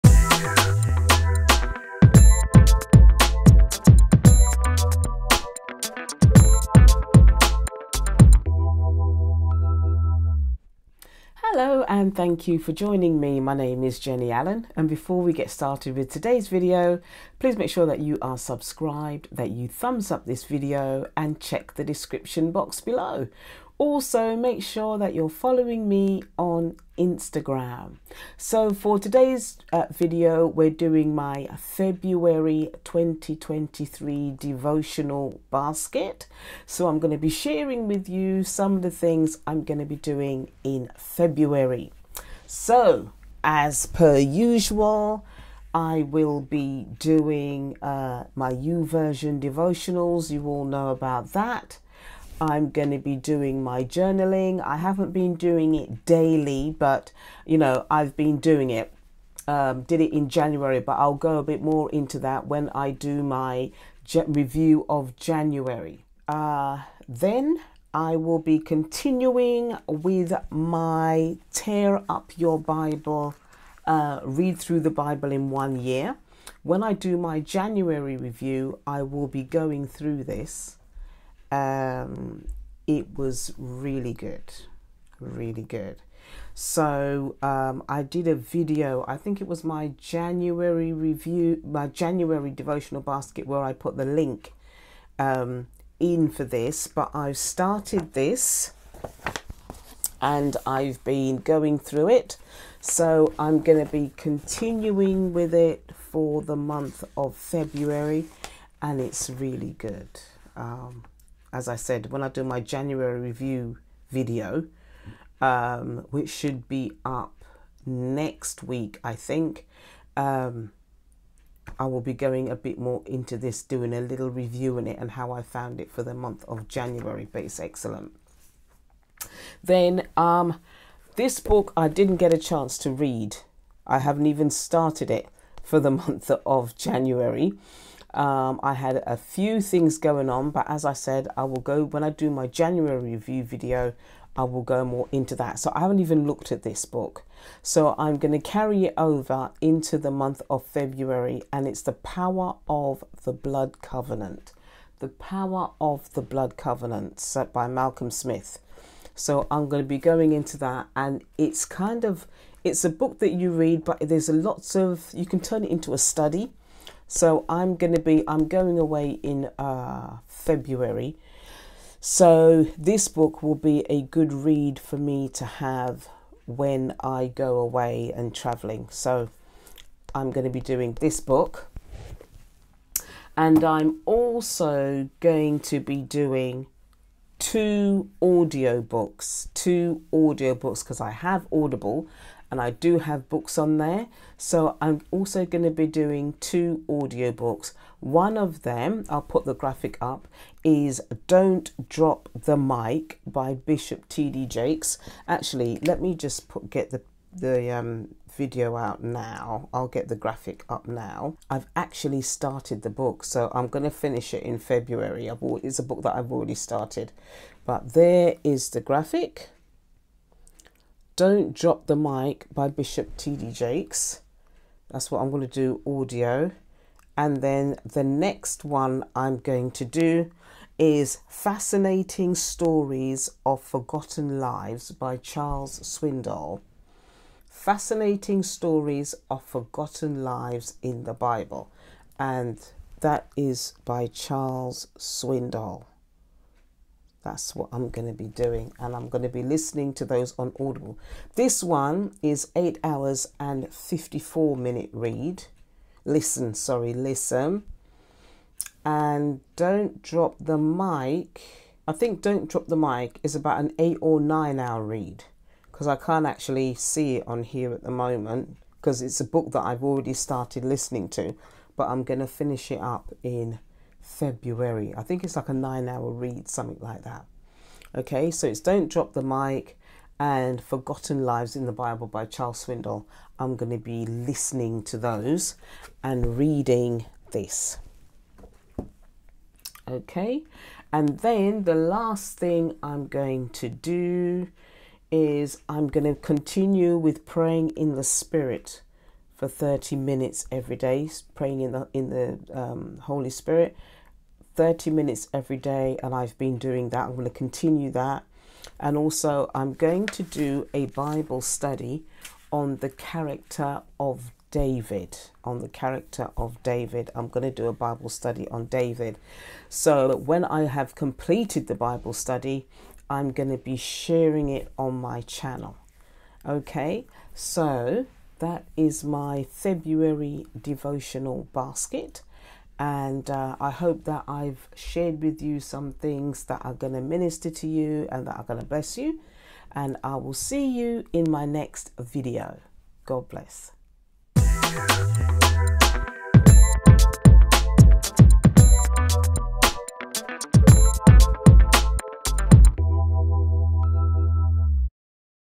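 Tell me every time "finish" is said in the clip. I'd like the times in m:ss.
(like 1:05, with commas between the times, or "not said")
3:33, 4:32.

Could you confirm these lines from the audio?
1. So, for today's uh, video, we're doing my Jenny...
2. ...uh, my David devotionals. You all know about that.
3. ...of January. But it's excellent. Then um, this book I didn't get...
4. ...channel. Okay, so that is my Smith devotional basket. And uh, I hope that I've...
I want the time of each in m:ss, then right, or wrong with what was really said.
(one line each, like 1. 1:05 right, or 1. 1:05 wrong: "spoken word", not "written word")
1. 0:28 wrong: "February", not "Jenny"
2. 0:47 wrong: "YouVersion", not "David"
3. 2:06 right
4. 5:25 wrong: "February", not "Smith".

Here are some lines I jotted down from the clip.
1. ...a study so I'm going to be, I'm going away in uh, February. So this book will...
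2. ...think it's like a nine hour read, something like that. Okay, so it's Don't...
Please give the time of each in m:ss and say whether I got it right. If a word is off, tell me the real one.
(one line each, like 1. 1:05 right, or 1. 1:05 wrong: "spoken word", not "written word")
1. 2:45 right
2. 4:35 right.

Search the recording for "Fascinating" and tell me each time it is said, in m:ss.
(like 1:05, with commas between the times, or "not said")
3:51, 3:57.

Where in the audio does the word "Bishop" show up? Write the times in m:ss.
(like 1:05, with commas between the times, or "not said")
3:23, 3:42.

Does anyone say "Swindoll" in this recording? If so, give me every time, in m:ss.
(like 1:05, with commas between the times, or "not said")
3:55, 4:04, 4:42.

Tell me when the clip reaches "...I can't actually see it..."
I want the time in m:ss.
4:25.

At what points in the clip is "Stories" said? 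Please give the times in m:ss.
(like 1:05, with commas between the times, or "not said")
3:52, 3:58.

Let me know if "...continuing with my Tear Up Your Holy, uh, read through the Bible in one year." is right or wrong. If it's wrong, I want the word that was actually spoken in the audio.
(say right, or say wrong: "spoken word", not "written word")
wrong: "Bible", not "Holy".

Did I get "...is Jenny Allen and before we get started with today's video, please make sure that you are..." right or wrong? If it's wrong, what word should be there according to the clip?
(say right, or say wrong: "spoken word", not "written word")
right.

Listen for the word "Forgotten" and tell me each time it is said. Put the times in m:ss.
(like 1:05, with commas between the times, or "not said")
3:53, 3:59, 4:40.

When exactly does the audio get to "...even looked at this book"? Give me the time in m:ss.
2:25.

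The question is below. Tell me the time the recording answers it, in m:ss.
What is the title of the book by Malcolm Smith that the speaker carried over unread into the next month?
2:34.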